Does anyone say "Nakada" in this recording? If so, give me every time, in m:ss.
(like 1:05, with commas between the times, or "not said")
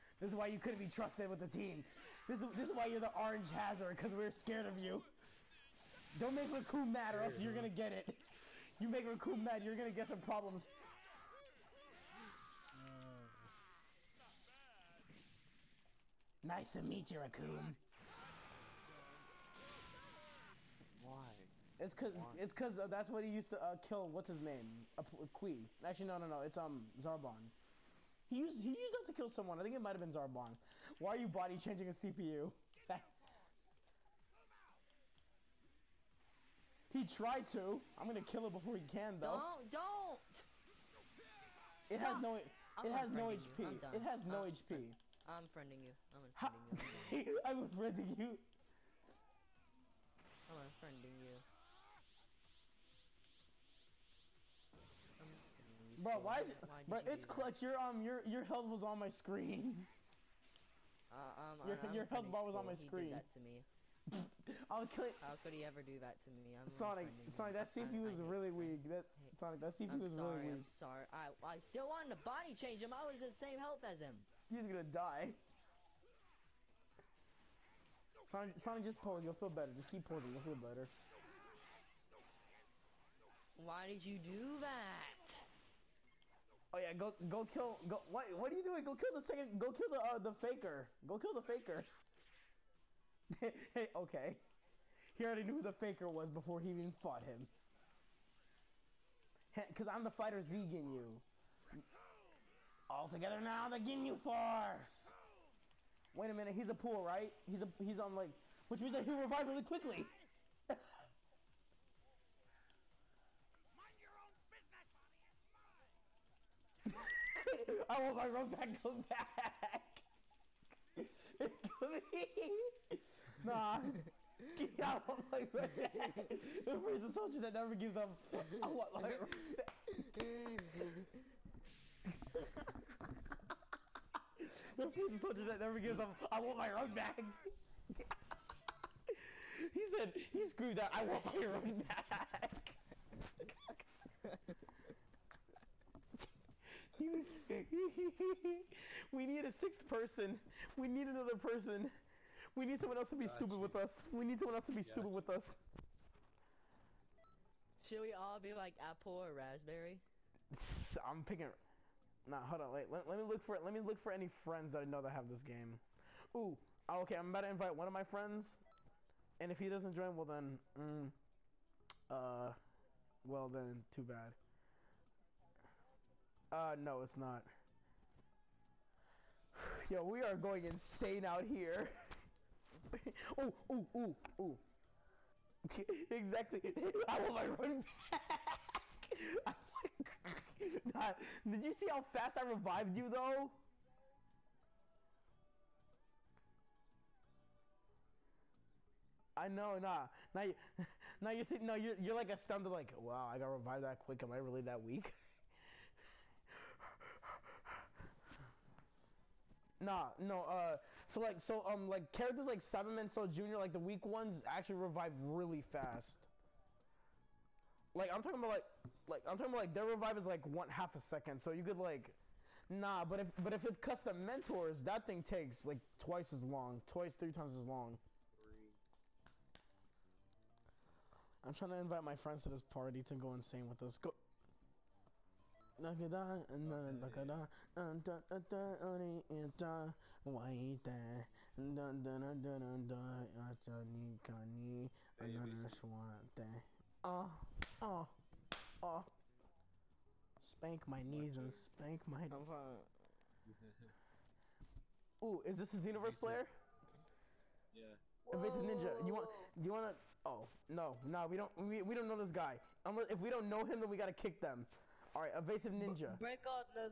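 3:55.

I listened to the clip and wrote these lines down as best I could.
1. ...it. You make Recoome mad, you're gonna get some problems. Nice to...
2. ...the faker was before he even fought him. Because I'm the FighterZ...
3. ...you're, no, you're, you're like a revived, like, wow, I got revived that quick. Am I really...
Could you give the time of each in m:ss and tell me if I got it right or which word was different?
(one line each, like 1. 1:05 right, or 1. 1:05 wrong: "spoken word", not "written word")
1. 0:07 right
2. 1:35 right
3. 3:21 wrong: "stunned", not "revived".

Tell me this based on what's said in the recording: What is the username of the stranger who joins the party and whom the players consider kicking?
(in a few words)
Evasive Ninja.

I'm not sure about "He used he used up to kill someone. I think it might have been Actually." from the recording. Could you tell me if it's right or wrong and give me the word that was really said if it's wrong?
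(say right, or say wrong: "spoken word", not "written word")
wrong: "Zarbon", not "Actually".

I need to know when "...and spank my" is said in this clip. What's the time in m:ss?
4:11.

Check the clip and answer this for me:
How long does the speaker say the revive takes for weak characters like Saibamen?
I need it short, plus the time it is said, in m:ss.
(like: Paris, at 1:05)
half a second, at 3:40.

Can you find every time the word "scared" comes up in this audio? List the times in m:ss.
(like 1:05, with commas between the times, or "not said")
0:04.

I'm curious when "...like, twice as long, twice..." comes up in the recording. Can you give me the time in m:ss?
3:45.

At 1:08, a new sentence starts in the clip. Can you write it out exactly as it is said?
That Sonic, that CPU I'm was sorry, really weak.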